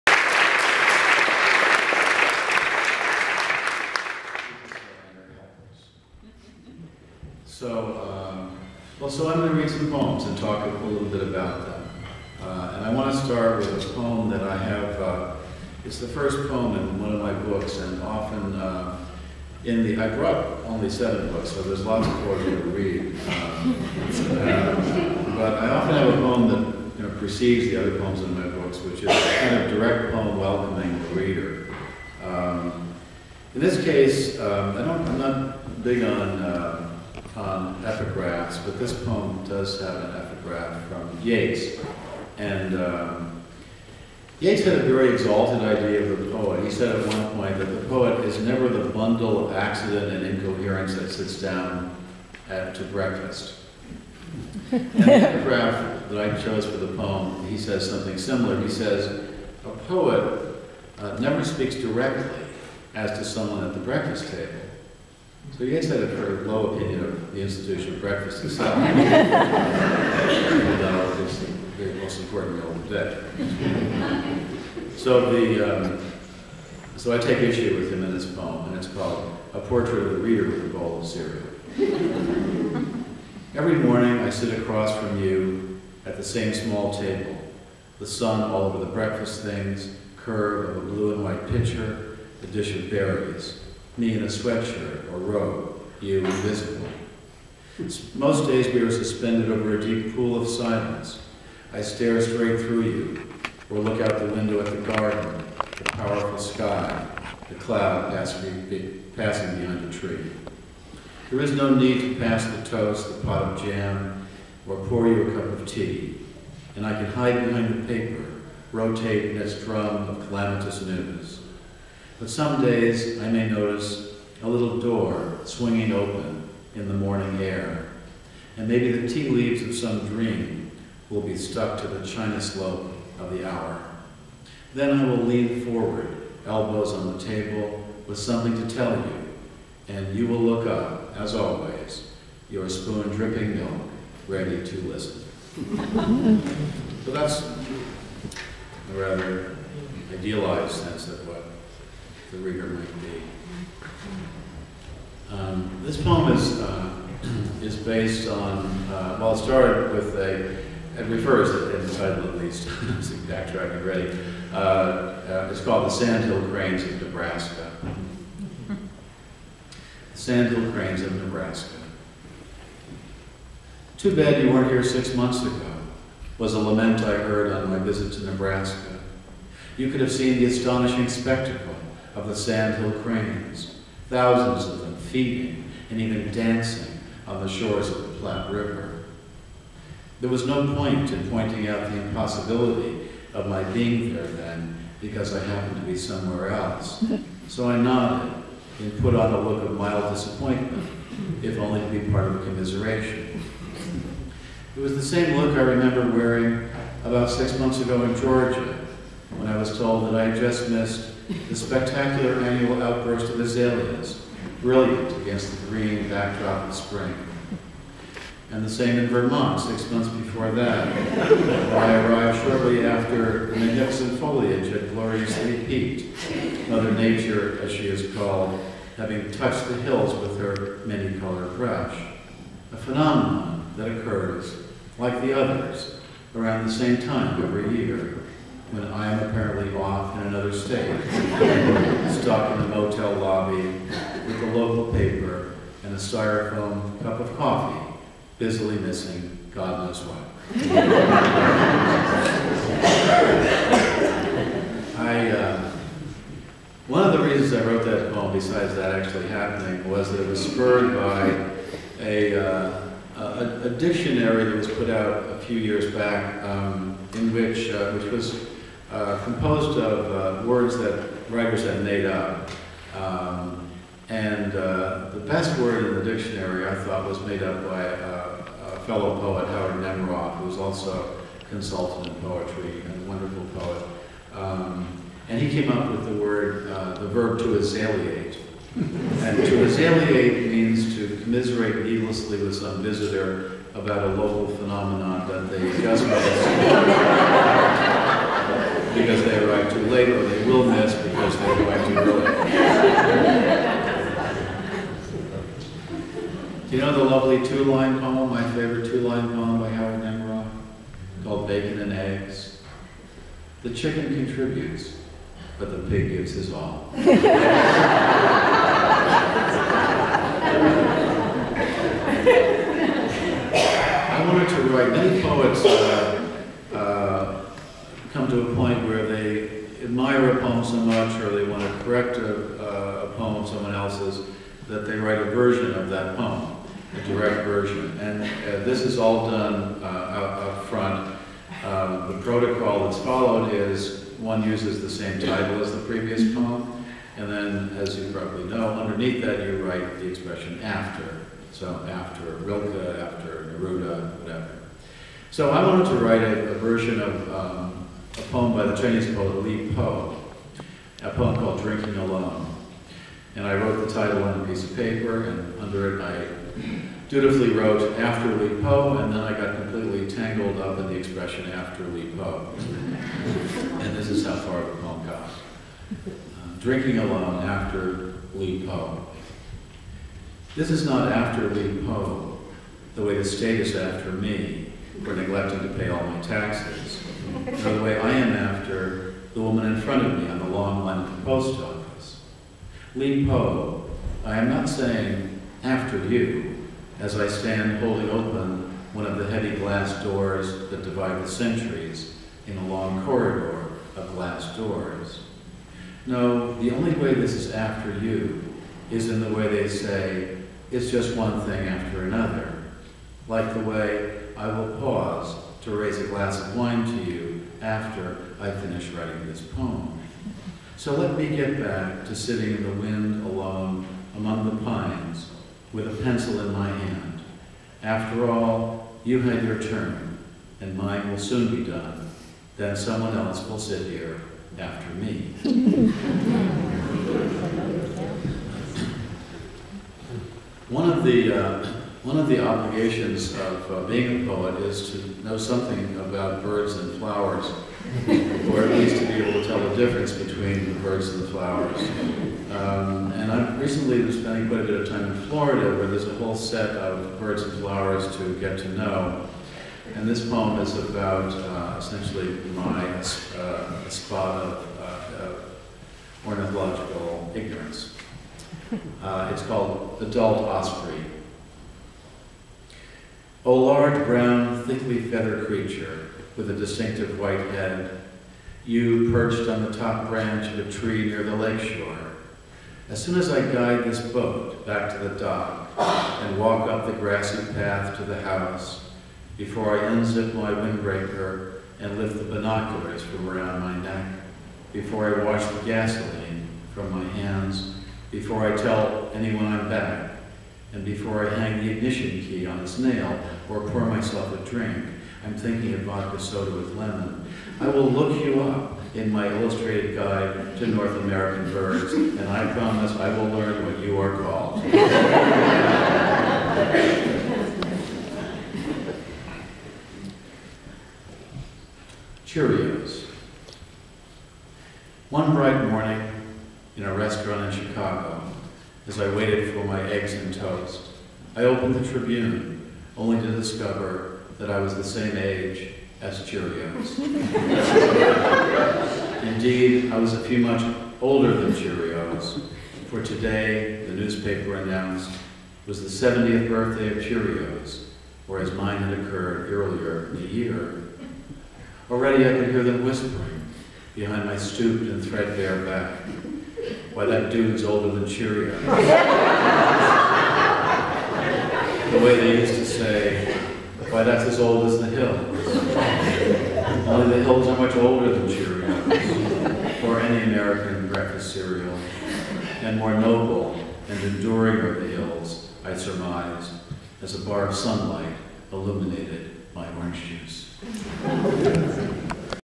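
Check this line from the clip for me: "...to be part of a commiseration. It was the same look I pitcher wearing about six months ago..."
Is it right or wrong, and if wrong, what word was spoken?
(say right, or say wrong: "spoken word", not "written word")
wrong: "remember", not "pitcher".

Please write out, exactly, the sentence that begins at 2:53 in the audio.
Too bad you weren't here six months ago, was a lament I heard on my visit to Nebraska.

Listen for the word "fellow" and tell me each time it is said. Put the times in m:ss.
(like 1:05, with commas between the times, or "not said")
4:38.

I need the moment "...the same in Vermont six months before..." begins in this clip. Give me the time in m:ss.
3:38.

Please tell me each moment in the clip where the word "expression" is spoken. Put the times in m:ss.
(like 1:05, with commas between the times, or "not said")
5:50, 6:10.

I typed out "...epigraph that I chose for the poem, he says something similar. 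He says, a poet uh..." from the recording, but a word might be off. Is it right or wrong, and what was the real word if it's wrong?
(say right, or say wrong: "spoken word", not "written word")
right.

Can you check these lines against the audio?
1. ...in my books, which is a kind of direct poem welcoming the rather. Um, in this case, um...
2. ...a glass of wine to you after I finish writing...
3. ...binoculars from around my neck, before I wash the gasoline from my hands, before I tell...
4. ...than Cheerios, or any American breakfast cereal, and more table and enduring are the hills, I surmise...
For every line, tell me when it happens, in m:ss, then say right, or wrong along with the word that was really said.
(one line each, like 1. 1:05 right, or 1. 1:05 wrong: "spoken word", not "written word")
1. 0:28 wrong: "reader", not "rather"
2. 6:55 right
3. 8:12 right
4. 9:28 wrong: "noble", not "table".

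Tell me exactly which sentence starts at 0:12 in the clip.
Uh, and I want to start with a poem that I have.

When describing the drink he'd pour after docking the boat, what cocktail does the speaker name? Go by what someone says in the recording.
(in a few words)
vodka soda with lemon.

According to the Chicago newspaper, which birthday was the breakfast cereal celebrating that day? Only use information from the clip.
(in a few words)
70th.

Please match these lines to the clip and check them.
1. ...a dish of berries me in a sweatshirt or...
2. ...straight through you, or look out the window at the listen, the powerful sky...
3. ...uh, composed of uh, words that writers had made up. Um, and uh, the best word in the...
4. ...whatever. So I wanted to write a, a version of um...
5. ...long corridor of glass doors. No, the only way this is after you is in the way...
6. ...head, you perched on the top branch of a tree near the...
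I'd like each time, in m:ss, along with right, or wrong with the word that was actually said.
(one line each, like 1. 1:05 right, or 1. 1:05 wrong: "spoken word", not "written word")
1. 1:32 right
2. 1:42 wrong: "garden", not "listen"
3. 4:28 right
4. 5:54 right
5. 6:42 right
6. 7:57 right.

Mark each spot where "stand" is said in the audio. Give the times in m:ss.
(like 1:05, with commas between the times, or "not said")
6:37.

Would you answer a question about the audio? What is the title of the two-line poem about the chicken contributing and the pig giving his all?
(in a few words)
Bacon and Eggs.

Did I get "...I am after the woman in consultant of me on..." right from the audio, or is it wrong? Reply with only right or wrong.
wrong.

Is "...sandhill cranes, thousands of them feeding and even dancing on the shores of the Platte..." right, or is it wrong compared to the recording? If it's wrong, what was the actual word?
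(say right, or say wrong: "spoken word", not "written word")
right.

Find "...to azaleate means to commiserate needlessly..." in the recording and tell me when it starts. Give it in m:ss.
4:49.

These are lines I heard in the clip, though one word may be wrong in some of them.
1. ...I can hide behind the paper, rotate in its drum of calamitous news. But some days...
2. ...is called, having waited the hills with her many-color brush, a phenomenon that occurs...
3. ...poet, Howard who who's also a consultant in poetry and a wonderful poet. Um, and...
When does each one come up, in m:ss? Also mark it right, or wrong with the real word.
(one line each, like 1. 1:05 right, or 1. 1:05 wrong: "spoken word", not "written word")
1. 1:56 right
2. 3:47 wrong: "touched", not "waited"
3. 4:39 right.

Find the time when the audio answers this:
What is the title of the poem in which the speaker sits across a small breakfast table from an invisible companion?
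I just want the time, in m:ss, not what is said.
1:19.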